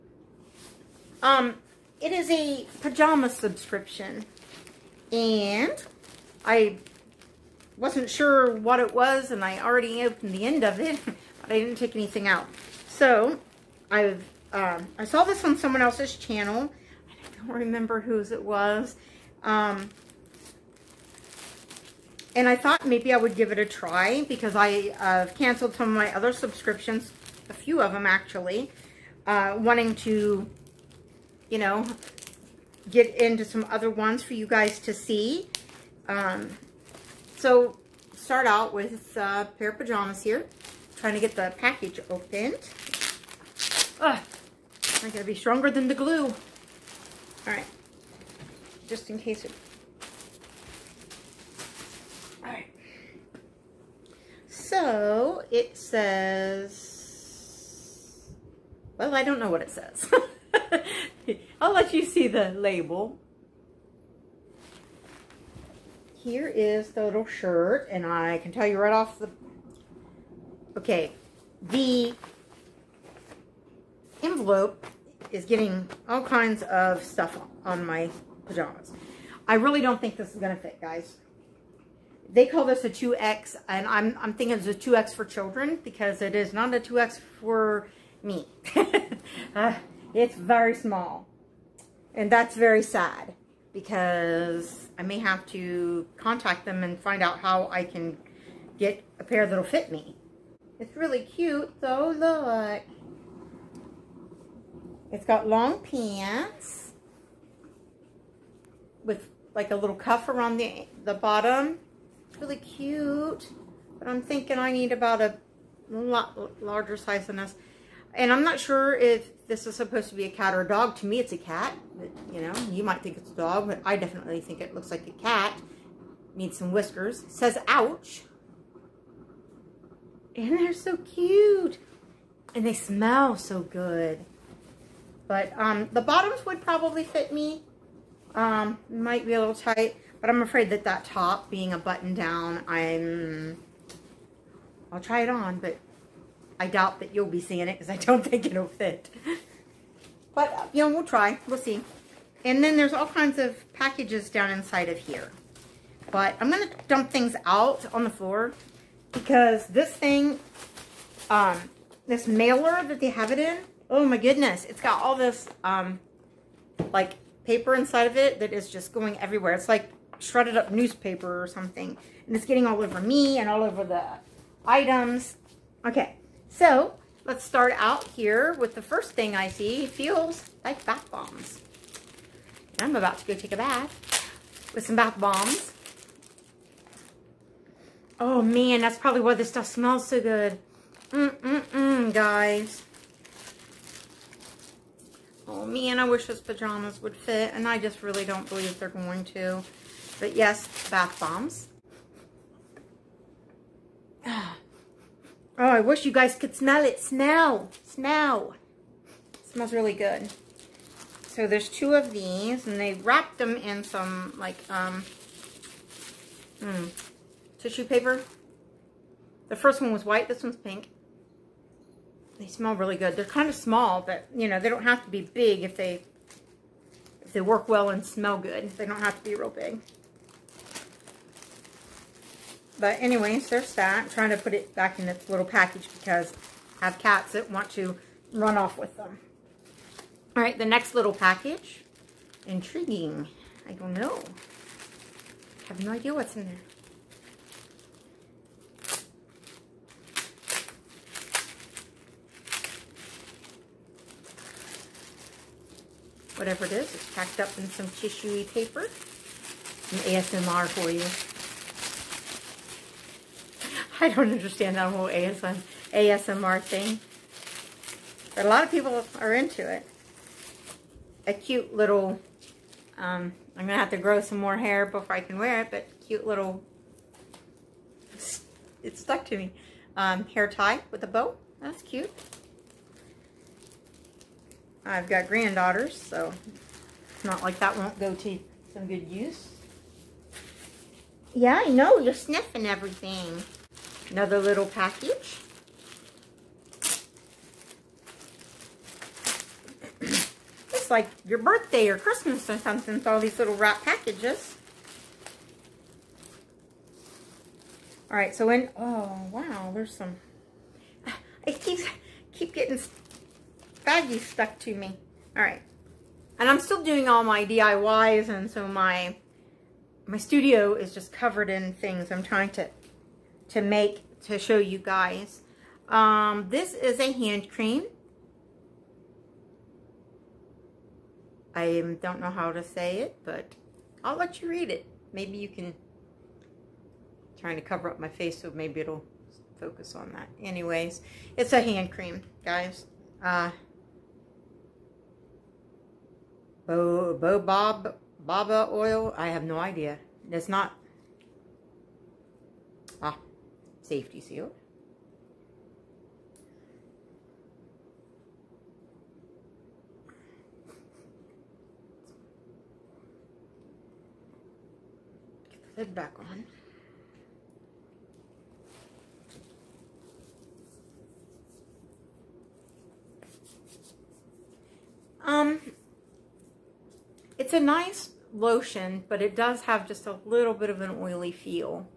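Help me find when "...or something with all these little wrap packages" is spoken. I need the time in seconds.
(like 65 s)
302 s.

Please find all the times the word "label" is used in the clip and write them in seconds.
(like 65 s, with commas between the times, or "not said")
62 s.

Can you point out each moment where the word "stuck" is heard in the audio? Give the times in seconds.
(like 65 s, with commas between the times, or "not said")
278 s, 314 s.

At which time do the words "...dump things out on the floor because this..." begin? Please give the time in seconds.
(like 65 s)
156 s.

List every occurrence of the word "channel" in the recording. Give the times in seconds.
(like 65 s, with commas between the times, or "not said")
16 s.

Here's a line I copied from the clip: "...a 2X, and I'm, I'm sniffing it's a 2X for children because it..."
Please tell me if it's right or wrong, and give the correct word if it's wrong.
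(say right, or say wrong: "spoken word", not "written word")
wrong: "thinking", not "sniffing".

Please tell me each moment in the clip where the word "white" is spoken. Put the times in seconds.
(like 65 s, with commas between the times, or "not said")
220 s.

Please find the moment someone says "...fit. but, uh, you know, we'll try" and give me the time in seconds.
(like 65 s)
148 s.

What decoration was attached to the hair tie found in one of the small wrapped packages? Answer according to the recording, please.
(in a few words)
a bow.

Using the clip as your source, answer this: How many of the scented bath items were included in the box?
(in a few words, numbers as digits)
2.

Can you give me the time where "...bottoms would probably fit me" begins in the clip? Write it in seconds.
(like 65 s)
136 s.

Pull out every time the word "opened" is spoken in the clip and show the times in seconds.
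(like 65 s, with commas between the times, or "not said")
10 s, 42 s.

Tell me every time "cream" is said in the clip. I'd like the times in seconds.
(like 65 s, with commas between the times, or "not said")
327 s, 341 s.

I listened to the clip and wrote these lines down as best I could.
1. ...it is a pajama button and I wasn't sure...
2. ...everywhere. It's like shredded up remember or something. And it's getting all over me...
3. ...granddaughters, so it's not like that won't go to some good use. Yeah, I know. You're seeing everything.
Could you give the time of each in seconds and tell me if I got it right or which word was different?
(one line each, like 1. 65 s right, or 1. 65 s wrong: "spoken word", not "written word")
1. 1 s wrong: "subscription", not "button"
2. 169 s wrong: "newspaper", not "remember"
3. 285 s wrong: "sniffing", not "seeing".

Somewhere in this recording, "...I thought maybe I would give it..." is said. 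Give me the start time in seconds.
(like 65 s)
22 s.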